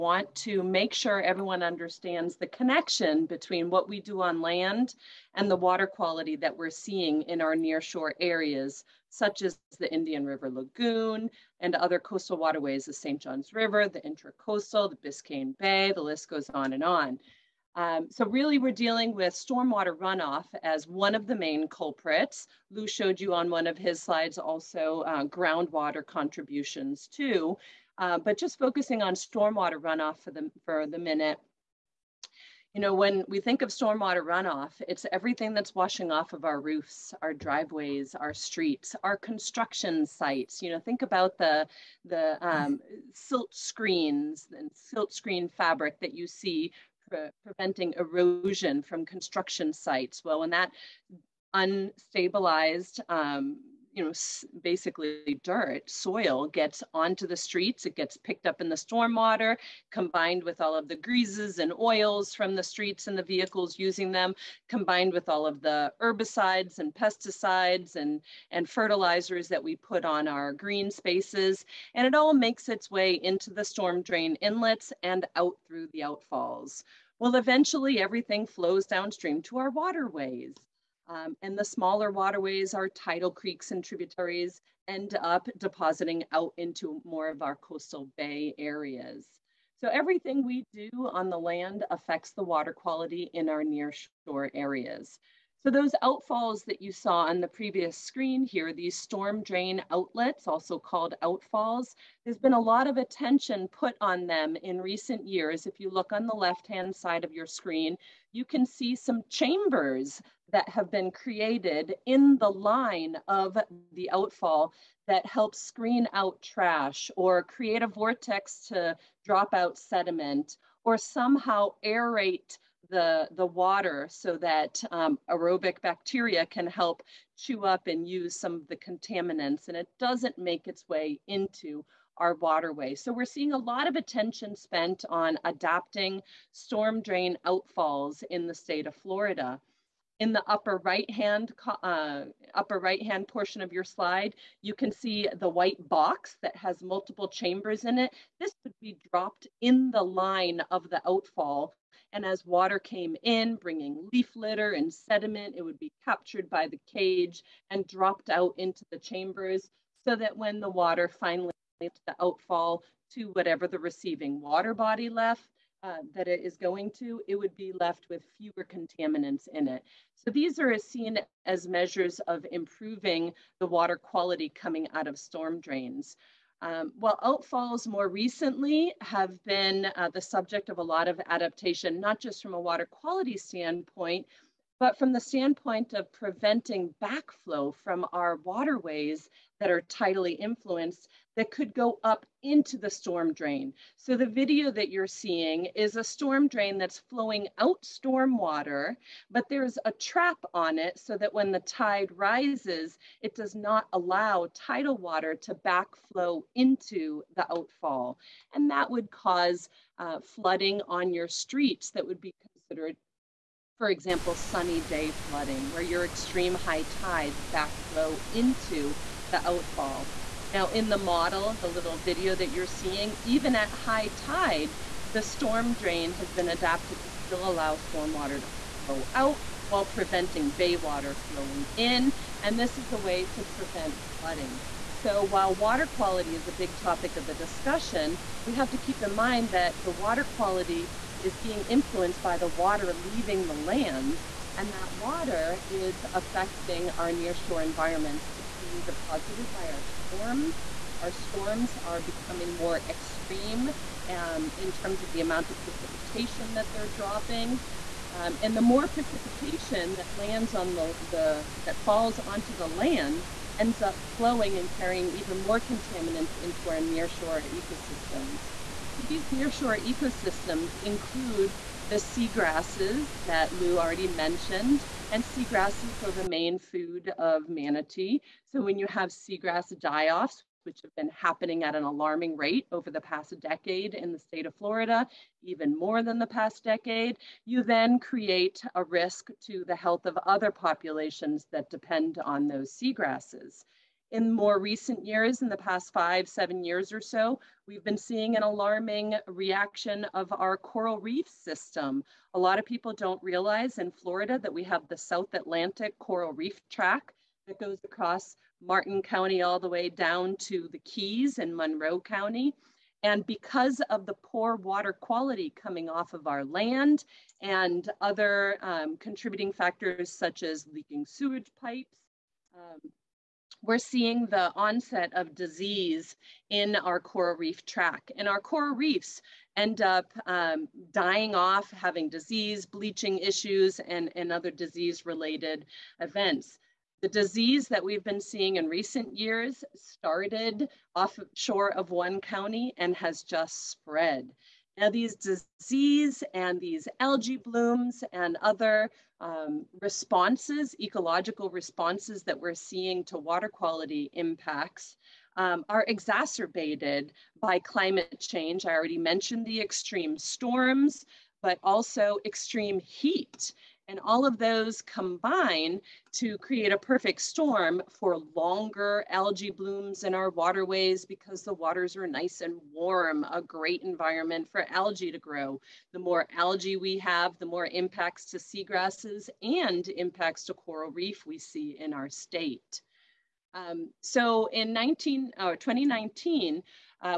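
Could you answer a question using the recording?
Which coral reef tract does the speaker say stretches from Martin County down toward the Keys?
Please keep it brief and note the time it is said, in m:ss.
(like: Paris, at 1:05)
South Atlantic coral reef tract, at 5:04.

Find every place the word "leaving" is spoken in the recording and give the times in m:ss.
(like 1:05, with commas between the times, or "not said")
4:02.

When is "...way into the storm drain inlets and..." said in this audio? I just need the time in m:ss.
1:12.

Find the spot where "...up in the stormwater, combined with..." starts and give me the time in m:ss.
0:58.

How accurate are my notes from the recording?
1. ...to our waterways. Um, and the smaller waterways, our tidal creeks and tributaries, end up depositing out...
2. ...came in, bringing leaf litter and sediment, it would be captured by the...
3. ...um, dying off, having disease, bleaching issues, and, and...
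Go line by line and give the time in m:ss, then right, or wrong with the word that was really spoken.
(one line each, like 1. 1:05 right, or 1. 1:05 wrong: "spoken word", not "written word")
1. 1:19 right
2. 2:32 right
3. 5:30 right.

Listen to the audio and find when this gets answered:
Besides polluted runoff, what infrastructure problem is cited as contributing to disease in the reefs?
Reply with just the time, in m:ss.
5:20.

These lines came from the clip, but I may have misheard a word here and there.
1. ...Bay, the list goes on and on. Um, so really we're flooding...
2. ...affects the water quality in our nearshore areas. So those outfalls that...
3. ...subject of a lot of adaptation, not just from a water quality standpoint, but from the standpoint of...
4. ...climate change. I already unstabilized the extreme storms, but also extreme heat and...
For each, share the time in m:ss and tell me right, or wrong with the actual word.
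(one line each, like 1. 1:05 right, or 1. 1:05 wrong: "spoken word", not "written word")
1. 0:15 wrong: "dealing", not "flooding"
2. 1:31 right
3. 3:00 right
4. 5:57 wrong: "mentioned", not "unstabilized".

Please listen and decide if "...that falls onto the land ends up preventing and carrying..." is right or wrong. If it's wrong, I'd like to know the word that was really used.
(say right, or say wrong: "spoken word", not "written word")
wrong: "flowing", not "preventing".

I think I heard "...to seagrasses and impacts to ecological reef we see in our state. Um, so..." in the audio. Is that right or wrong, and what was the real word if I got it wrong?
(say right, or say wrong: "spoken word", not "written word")
wrong: "coral", not "ecological".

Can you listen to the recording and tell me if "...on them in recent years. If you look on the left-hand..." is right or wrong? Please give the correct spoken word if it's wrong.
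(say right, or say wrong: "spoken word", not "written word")
right.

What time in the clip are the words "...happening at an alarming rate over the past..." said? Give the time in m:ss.
4:41.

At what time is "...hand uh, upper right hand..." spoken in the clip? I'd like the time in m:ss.
2:21.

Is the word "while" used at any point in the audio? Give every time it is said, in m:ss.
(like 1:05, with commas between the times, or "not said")
3:49, 3:55.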